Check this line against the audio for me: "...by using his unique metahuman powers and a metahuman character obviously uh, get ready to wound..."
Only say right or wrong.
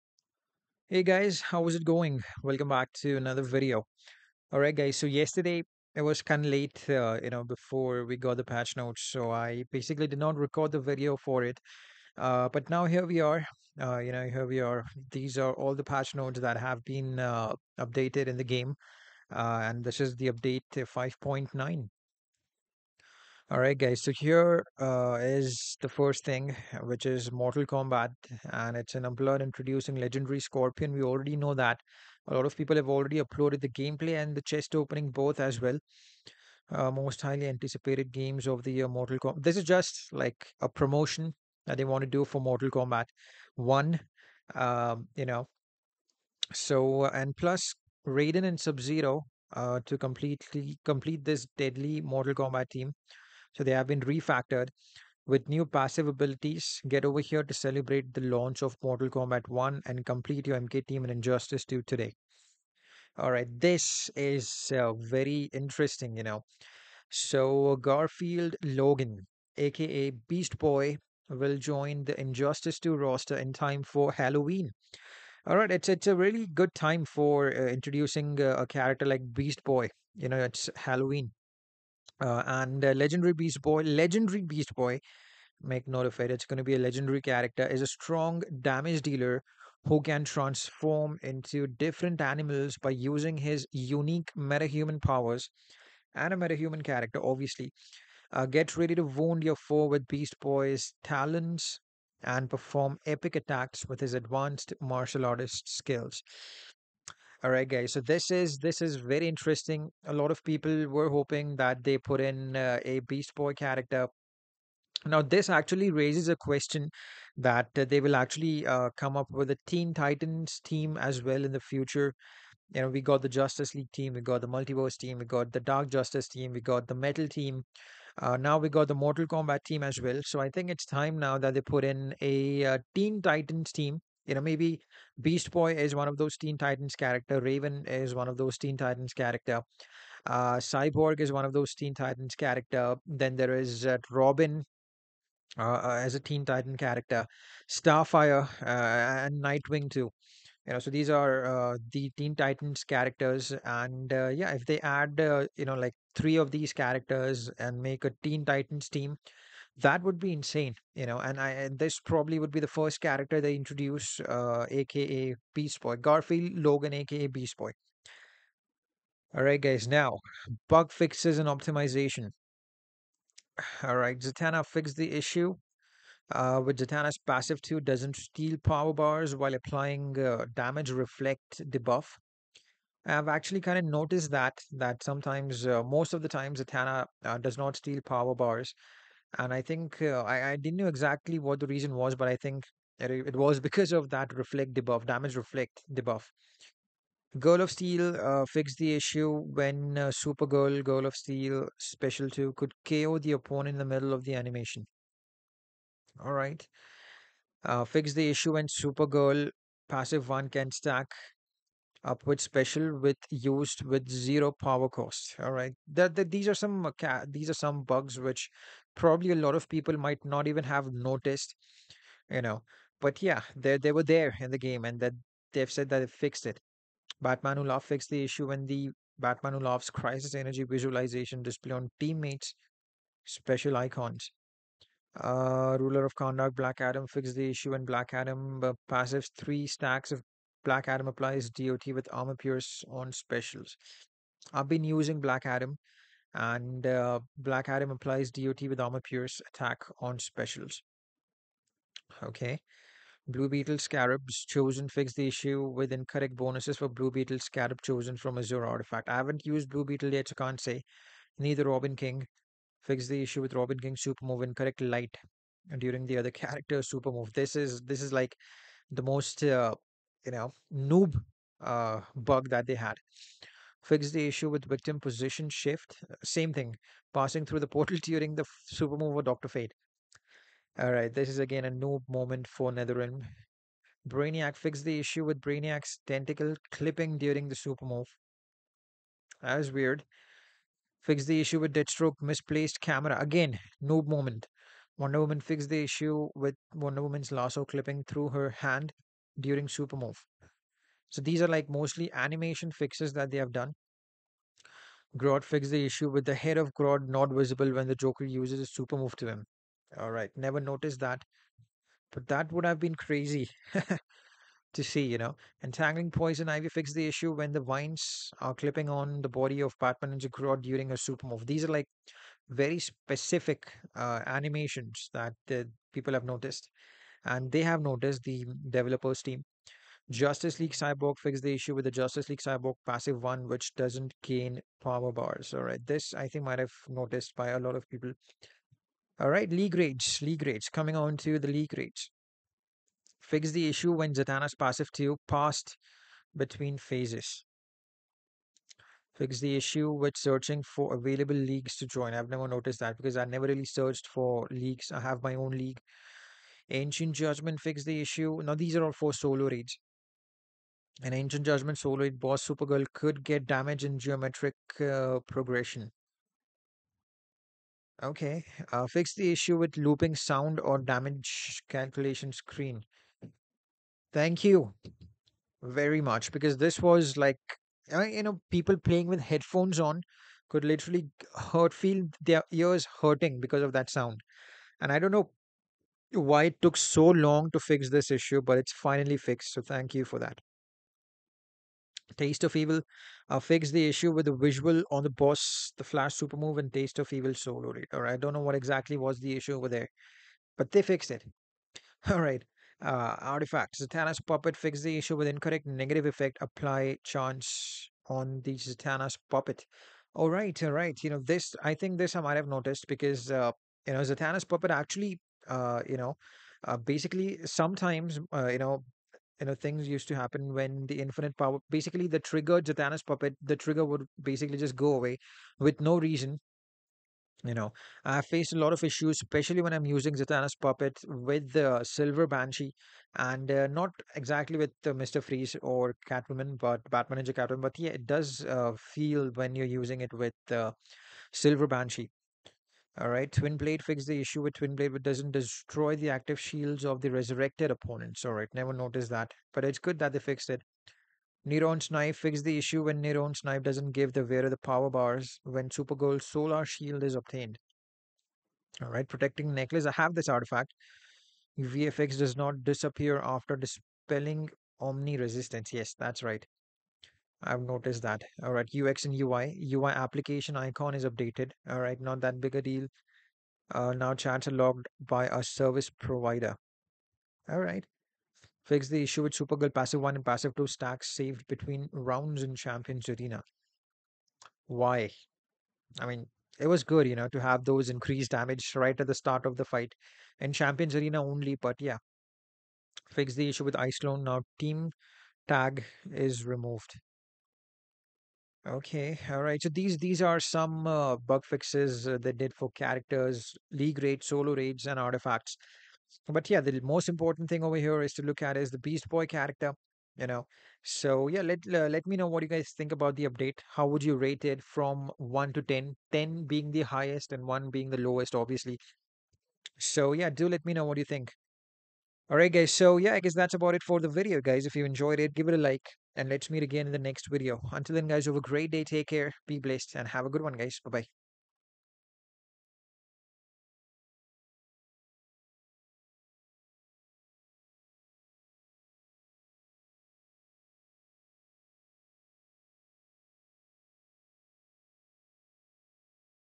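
right.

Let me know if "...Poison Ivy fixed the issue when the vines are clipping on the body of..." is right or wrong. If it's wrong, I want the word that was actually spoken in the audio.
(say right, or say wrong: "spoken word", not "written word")
right.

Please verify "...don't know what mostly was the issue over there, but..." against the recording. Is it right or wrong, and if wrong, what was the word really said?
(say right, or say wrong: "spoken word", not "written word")
wrong: "exactly", not "mostly".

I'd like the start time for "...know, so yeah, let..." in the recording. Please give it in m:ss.
8:30.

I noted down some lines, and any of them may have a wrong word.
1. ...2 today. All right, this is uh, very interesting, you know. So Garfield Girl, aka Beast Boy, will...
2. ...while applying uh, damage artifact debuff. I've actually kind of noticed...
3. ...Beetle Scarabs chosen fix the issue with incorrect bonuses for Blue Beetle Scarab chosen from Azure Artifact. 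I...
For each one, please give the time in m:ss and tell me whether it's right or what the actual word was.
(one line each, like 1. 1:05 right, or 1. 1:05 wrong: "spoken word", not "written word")
1. 1:01 wrong: "Logan", not "Girl"
2. 2:59 wrong: "reflect", not "artifact"
3. 4:13 right.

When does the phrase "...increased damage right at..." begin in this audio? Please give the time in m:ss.
8:07.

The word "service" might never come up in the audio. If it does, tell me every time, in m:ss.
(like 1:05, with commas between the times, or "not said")
7:55.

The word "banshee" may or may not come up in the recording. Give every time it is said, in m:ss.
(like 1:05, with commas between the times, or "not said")
7:12, 7:21.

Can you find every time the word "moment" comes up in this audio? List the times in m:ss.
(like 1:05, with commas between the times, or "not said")
4:42, 4:54.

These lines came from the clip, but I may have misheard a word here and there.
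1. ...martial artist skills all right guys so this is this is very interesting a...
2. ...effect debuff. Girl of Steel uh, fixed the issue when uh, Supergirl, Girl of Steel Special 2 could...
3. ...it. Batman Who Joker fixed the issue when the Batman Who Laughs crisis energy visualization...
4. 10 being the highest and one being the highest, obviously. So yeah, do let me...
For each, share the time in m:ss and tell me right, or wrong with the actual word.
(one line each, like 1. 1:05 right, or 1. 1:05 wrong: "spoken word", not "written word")
1. 1:44 right
2. 3:15 wrong: "reflect", not "effect"
3. 3:46 wrong: "Laughs", not "Joker"
4. 8:36 wrong: "lowest", not "highest".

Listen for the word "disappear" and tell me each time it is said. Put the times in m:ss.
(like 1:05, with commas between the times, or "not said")
7:42.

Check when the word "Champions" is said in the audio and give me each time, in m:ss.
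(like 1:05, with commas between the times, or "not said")
8:02, 8:10.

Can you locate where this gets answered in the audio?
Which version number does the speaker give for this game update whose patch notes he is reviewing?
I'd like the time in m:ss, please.
0:20.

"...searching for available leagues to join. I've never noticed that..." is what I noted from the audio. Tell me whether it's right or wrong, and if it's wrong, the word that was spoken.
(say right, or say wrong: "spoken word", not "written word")
right.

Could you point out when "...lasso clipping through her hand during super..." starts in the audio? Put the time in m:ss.
4:57.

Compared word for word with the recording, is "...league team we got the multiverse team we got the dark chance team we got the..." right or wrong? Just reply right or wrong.
wrong.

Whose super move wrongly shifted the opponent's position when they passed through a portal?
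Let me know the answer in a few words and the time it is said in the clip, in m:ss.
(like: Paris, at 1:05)
Dr. Fate, at 4:39.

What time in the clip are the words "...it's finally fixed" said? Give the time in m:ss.
6:28.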